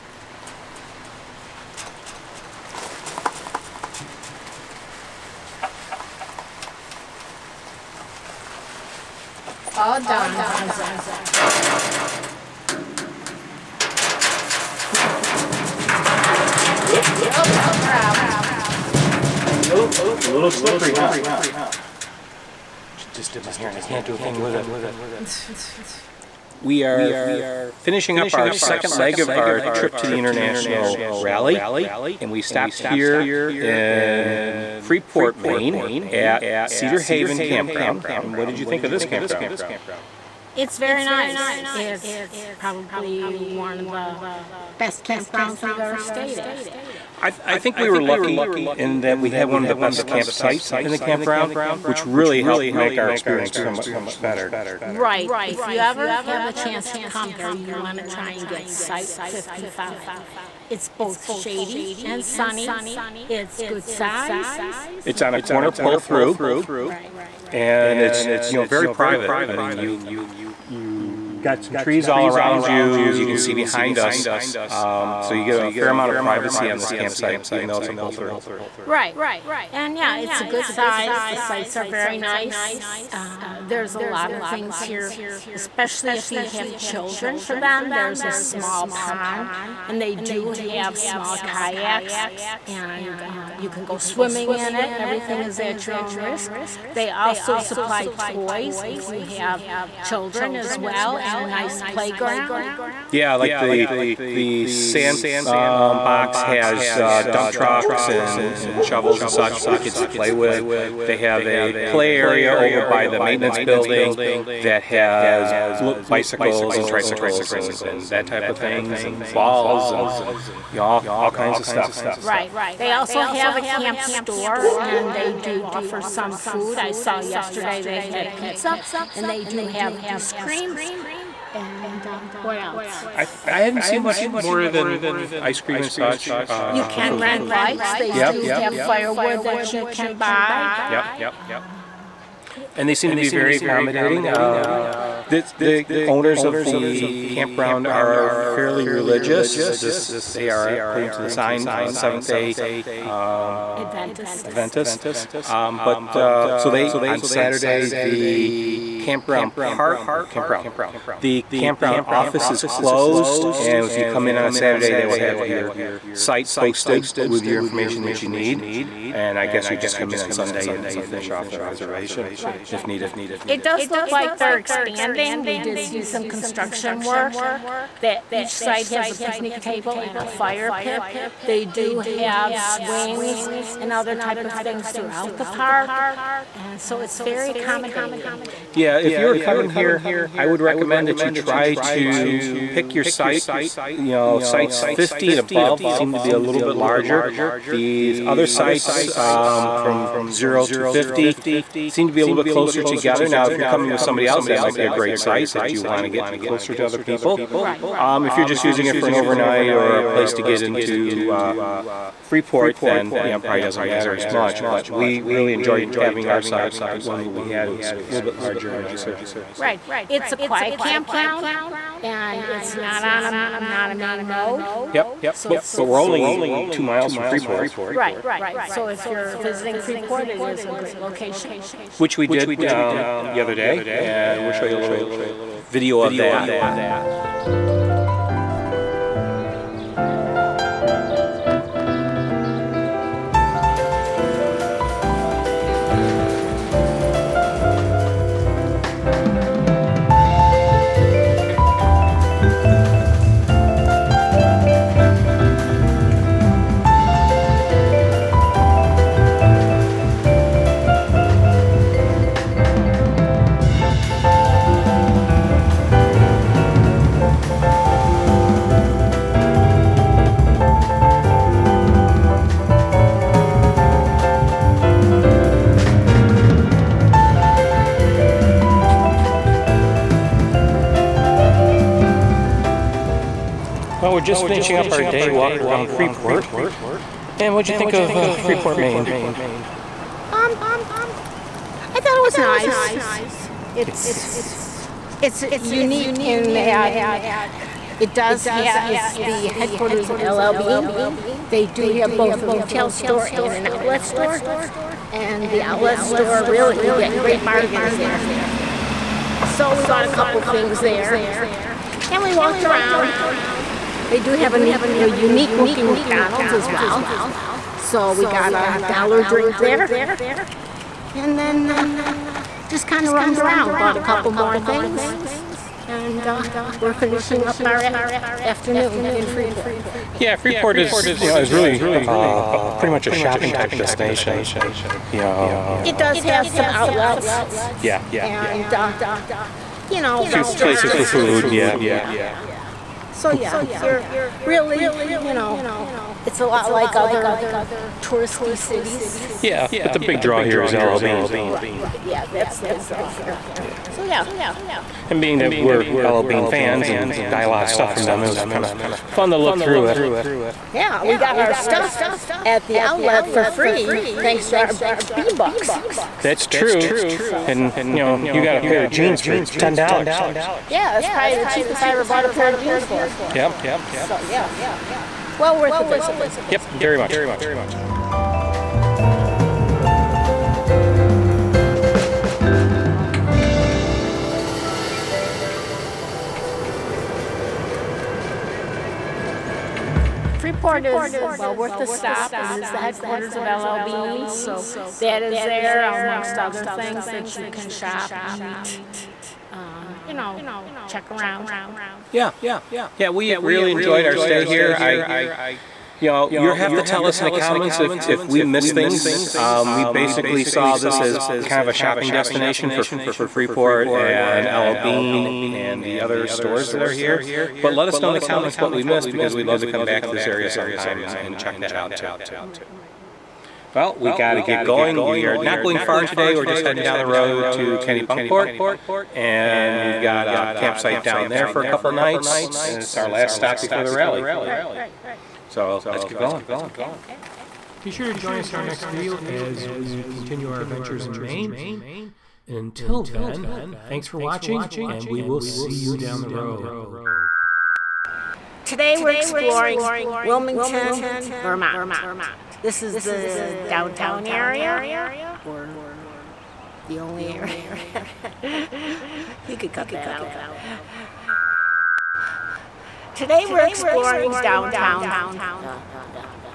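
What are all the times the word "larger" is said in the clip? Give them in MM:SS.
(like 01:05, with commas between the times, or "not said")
03:16, 03:38.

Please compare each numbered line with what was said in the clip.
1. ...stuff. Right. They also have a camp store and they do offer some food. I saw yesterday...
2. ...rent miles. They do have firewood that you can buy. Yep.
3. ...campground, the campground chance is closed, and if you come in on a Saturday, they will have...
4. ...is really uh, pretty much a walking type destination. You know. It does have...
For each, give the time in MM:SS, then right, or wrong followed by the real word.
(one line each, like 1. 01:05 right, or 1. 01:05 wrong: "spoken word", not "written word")
1. 02:01 right
2. 02:17 wrong: "bikes", not "miles"
3. 02:40 wrong: "office", not "chance"
4. 05:31 wrong: "shopping", not "walking".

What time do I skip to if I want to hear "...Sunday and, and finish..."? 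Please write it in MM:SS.
02:50.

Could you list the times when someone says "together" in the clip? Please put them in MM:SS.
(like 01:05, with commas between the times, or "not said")
03:22.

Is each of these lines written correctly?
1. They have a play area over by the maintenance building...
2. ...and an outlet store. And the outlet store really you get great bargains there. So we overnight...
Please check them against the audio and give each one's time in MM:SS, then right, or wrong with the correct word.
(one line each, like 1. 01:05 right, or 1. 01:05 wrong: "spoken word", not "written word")
1. 01:51 right
2. 05:03 wrong: "bought", not "overnight".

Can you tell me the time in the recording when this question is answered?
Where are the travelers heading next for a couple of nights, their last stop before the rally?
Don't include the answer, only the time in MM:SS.
07:07.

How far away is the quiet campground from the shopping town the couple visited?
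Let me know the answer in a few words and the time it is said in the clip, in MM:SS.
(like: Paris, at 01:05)
2 miles, at 03:46.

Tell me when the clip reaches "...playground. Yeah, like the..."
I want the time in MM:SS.
01:41.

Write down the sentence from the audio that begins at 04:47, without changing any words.
And what'd you think of uh, Freeport, Maine?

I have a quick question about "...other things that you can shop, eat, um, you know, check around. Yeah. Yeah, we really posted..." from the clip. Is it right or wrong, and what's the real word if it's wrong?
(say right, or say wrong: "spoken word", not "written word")
wrong: "enjoyed", not "posted".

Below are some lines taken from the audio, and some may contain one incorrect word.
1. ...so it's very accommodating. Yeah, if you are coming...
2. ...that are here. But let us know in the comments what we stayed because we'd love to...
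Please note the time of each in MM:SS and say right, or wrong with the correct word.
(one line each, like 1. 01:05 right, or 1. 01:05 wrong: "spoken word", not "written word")
1. 03:06 right
2. 06:56 wrong: "missed", not "stayed".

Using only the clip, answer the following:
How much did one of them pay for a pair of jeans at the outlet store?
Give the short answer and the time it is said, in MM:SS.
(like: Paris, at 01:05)
$10, at 06:09.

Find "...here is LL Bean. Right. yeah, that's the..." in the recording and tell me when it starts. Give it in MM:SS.
05:50.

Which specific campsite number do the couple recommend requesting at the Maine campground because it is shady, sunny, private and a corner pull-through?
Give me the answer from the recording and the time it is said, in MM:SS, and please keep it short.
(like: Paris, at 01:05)
55, at 00:58.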